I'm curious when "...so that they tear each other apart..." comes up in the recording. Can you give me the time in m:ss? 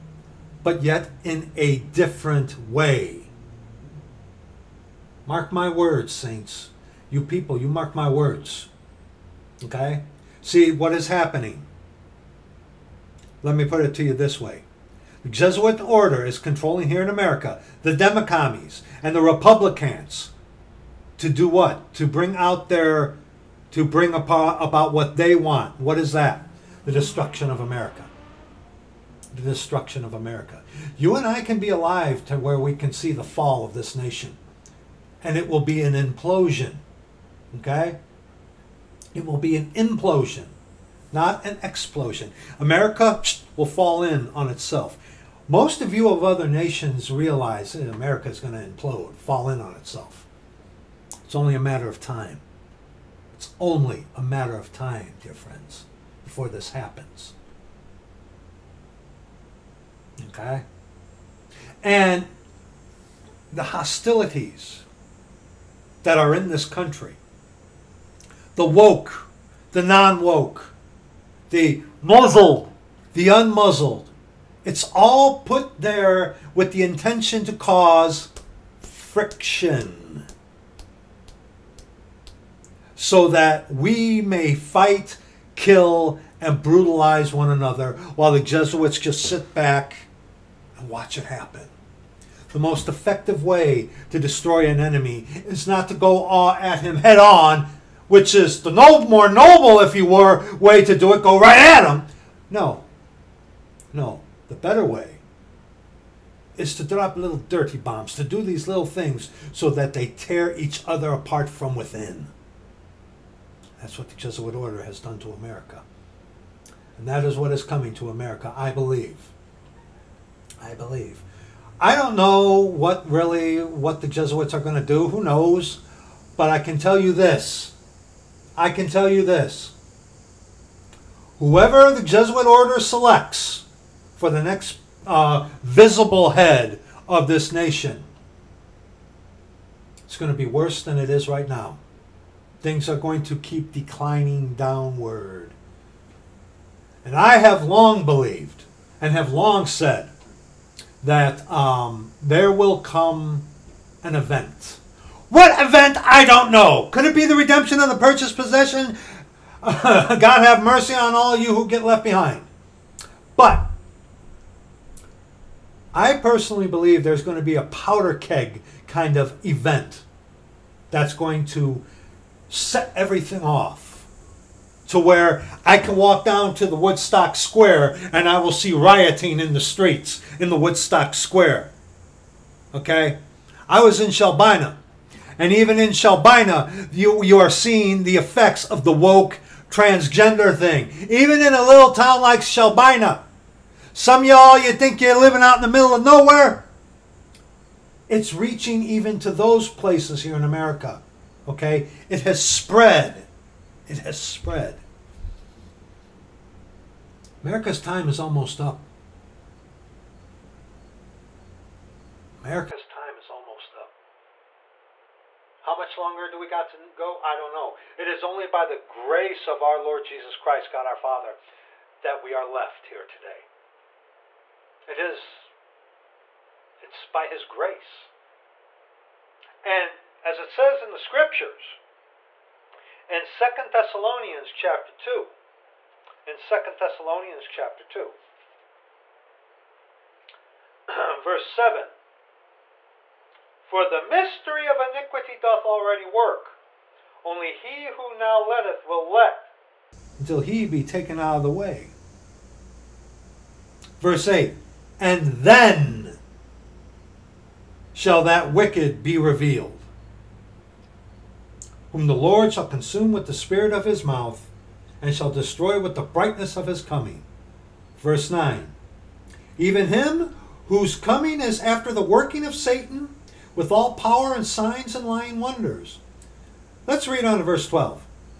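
1:49.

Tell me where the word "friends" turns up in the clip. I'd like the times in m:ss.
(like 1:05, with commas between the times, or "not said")
0:55.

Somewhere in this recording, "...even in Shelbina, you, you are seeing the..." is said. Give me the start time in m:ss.
3:05.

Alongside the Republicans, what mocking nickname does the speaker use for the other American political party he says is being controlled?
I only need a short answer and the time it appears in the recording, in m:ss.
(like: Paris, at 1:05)
Democommies, at 0:17.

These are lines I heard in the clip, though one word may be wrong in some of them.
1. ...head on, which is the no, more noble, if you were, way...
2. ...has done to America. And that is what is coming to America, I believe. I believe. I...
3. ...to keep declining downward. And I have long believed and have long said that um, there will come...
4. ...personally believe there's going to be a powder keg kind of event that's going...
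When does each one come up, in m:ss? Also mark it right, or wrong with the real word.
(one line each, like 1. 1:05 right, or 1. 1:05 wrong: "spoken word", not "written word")
1. 1:36 right
2. 1:54 right
3. 2:23 right
4. 2:46 right.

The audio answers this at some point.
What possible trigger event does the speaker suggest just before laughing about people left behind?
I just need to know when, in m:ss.
2:37.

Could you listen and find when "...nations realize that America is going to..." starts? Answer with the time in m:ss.
0:46.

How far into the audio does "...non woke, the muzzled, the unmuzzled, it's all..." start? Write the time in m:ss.
1:09.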